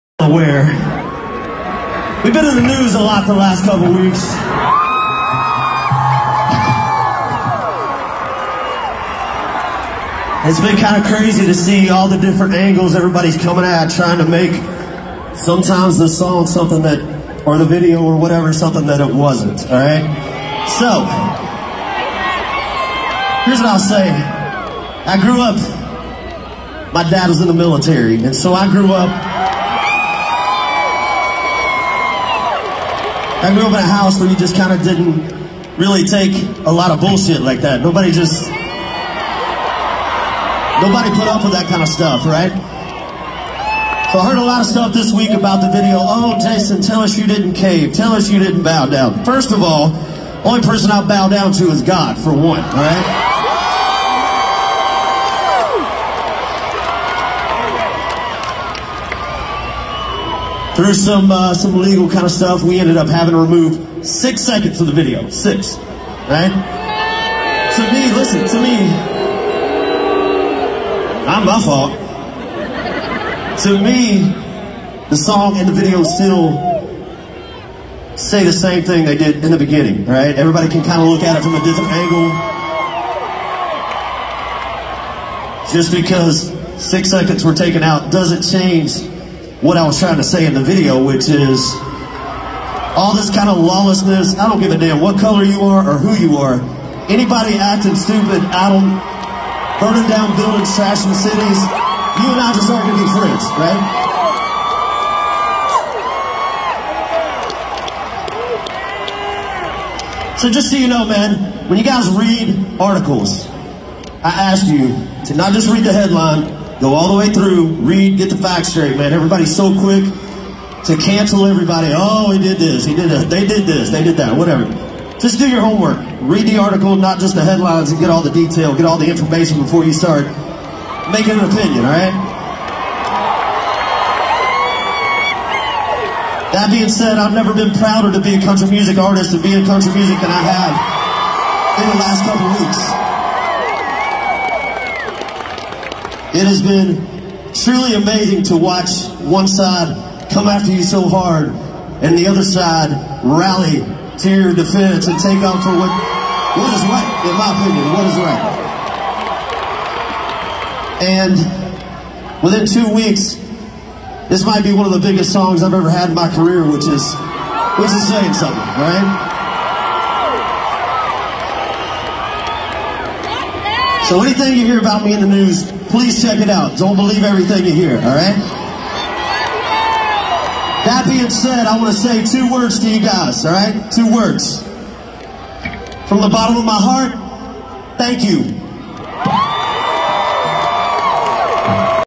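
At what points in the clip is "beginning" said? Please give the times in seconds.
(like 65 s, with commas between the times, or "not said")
79 s.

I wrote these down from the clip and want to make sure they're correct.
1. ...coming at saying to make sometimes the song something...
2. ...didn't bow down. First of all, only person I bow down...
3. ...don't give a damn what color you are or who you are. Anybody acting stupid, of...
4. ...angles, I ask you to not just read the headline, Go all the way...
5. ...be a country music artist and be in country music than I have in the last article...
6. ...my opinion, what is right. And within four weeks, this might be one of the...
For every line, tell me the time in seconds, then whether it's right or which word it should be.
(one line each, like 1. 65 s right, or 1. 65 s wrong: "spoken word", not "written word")
1. 13 s wrong: "trying", not "saying"
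2. 48 s right
3. 94 s right
4. 112 s wrong: "articles", not "angles"
5. 138 s wrong: "couple", not "article"
6. 157 s wrong: "two", not "four".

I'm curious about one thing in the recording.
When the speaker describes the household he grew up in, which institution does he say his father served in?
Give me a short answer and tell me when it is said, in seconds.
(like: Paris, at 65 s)
the military, at 27 s.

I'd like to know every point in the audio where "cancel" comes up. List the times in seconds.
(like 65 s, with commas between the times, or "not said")
120 s.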